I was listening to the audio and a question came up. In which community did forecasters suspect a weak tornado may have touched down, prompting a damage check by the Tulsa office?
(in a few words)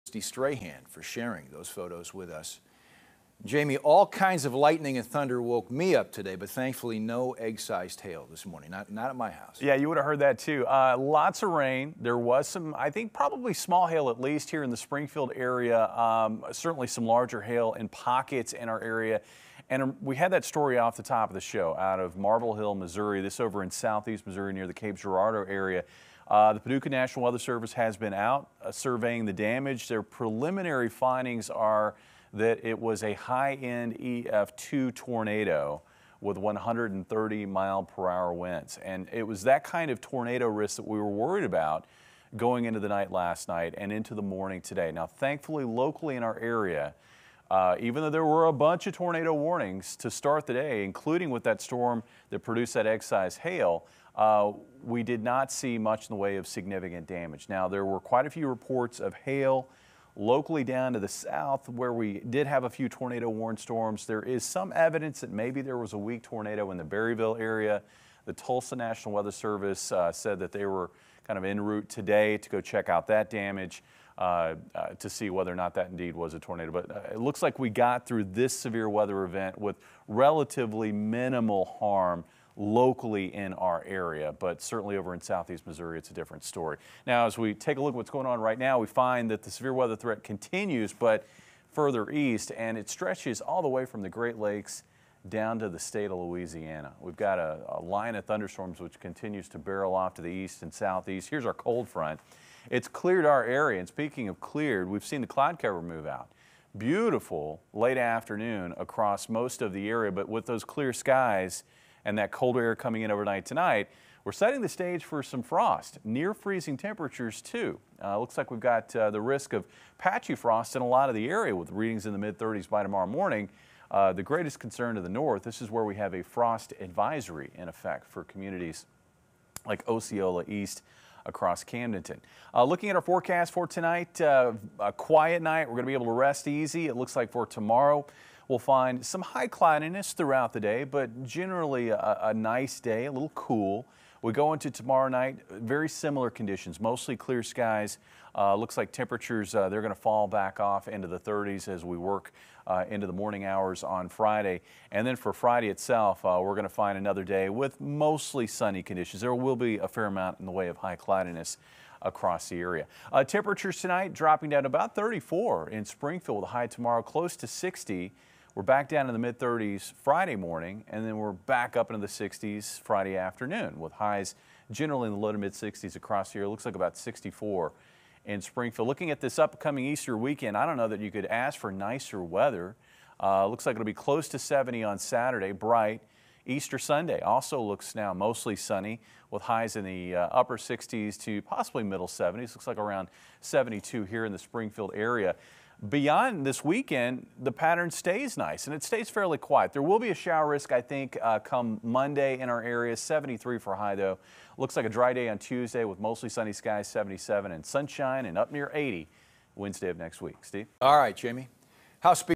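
Berryville.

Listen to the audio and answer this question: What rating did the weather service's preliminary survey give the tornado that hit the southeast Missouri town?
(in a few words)
High-end EF2.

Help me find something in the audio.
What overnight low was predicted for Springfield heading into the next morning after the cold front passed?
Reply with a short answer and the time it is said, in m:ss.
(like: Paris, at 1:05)
34, at 2:44.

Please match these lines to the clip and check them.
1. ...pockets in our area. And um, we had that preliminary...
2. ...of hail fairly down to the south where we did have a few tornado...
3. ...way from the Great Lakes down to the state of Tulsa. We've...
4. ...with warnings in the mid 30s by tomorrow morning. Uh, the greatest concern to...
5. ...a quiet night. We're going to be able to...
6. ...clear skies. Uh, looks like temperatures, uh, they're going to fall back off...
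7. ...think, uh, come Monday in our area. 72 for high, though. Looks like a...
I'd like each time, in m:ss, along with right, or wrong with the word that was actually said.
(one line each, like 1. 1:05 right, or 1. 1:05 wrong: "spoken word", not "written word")
1. 0:17 wrong: "story", not "preliminary"
2. 0:59 wrong: "locally", not "fairly"
3. 1:33 wrong: "Louisiana", not "Tulsa"
4. 2:01 wrong: "readings", not "warnings"
5. 2:14 right
6. 2:27 right
7. 3:20 wrong: "73", not "72".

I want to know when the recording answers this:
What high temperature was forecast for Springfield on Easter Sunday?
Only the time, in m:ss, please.
3:13.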